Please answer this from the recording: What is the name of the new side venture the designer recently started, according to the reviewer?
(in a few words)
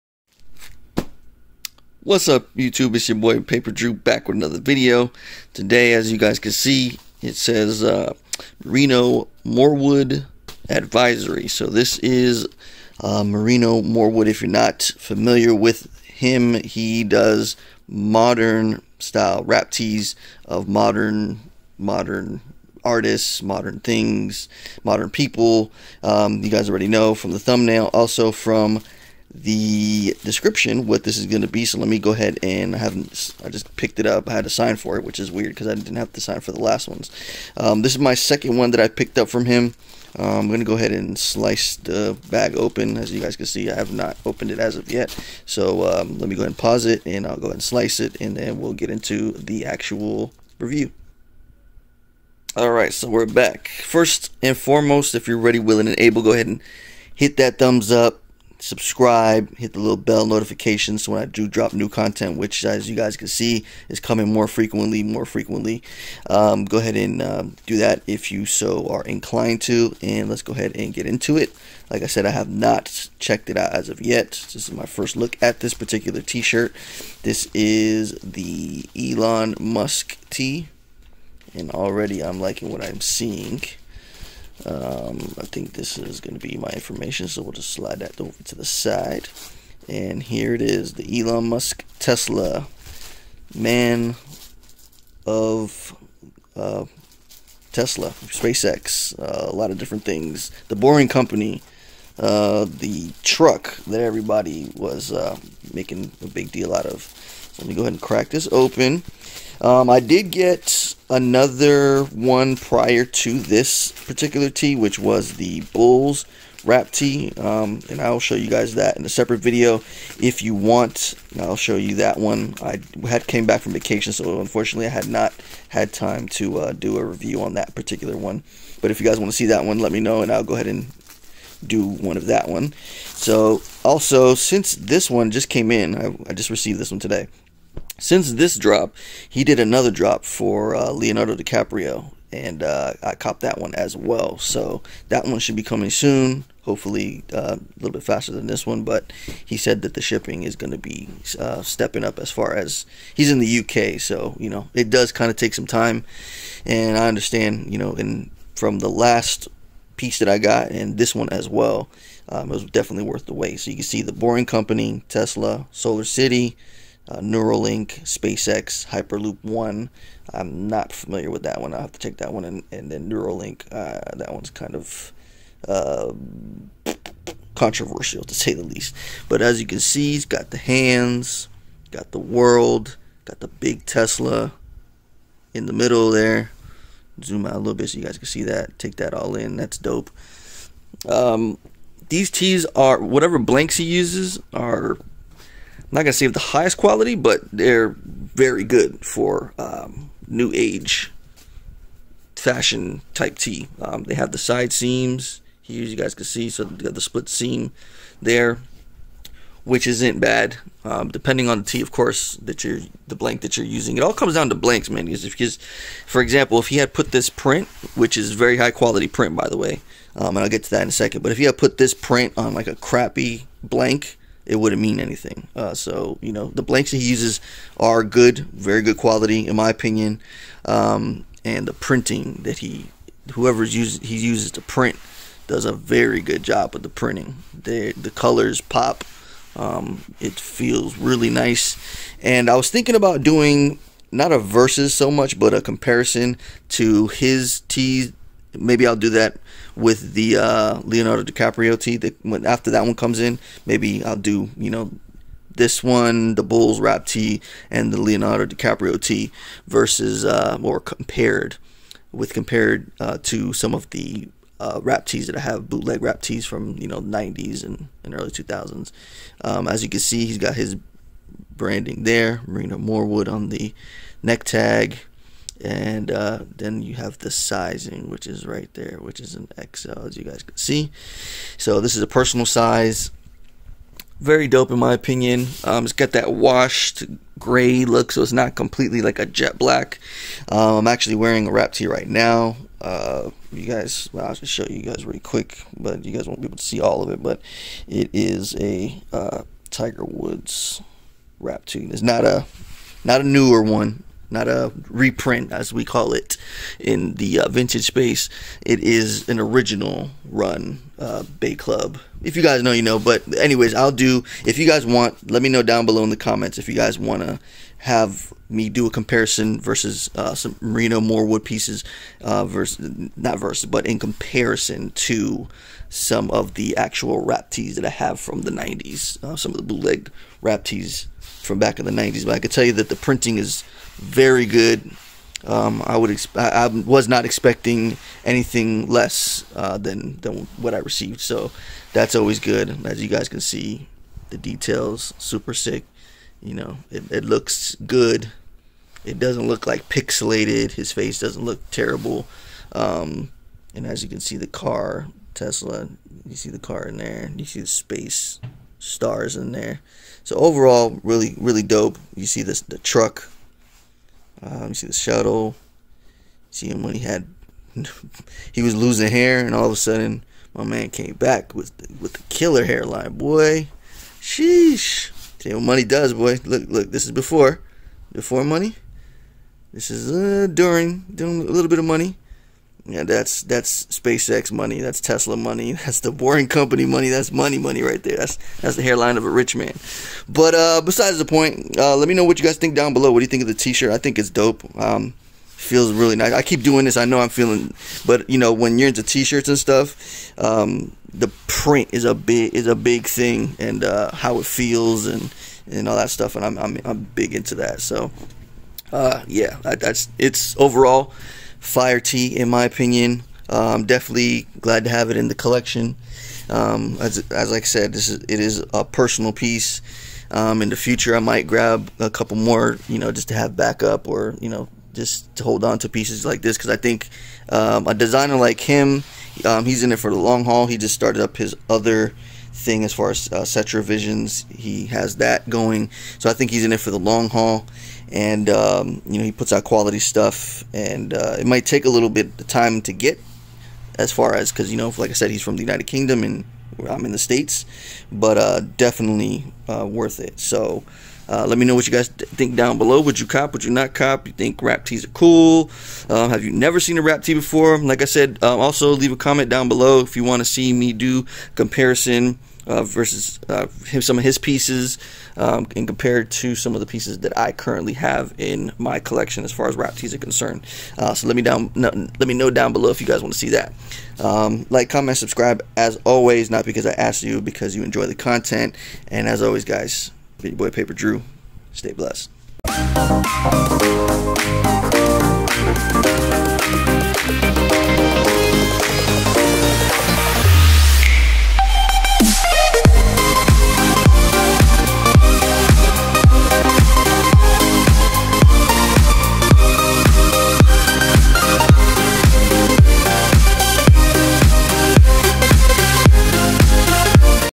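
Setra Visions.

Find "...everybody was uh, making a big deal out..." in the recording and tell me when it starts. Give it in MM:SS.
01:43.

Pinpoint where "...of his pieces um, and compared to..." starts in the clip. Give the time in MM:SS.
07:44.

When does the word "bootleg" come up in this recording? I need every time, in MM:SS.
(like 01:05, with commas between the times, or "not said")
04:25, 05:29.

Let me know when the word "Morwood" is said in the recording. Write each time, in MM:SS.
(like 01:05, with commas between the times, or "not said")
00:09, 00:13, 04:32, 05:21.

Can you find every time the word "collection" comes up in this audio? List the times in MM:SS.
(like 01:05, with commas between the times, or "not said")
06:55, 07:48.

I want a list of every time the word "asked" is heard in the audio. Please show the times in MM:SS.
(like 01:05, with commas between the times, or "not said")
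07:56.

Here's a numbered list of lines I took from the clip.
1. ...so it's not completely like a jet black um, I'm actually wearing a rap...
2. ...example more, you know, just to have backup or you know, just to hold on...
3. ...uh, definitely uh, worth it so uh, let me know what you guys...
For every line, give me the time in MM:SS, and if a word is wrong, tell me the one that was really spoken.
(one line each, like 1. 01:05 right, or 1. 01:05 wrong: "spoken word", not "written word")
1. 04:48 right
2. 07:02 wrong: "couple", not "example"
3. 07:28 right.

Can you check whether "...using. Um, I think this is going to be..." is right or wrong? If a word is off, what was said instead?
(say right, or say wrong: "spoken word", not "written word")
wrong: "seeing", not "using".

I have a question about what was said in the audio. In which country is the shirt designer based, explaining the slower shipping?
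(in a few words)
UK.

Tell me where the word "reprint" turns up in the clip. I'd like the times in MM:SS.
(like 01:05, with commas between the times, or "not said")
05:04.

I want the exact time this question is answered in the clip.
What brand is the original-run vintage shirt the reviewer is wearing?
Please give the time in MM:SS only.
05:11.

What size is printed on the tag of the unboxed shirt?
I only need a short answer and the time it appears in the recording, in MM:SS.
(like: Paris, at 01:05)
XL, at 04:39.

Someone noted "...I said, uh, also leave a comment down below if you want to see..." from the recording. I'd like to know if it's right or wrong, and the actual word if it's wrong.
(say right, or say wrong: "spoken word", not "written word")
right.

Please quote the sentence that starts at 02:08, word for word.
But if you guys want to see that one, let me know, and I'll go ahead and do one of that one.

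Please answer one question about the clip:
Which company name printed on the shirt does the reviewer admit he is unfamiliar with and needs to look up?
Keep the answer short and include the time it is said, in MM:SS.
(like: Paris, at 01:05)
Hyperloop One, at 02:48.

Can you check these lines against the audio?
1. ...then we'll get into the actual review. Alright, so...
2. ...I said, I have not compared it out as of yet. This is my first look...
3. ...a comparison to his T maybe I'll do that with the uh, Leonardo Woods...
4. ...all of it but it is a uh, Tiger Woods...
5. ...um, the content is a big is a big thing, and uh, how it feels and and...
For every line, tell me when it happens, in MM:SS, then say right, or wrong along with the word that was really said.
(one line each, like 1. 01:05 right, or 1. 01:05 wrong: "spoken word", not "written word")
1. 00:48 right
2. 01:12 wrong: "checked", not "compared"
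3. 04:05 wrong: "DiCaprio", not "Woods"
4. 04:56 right
5. 06:40 wrong: "print", not "content".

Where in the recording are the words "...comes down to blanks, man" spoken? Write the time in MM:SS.
03:34.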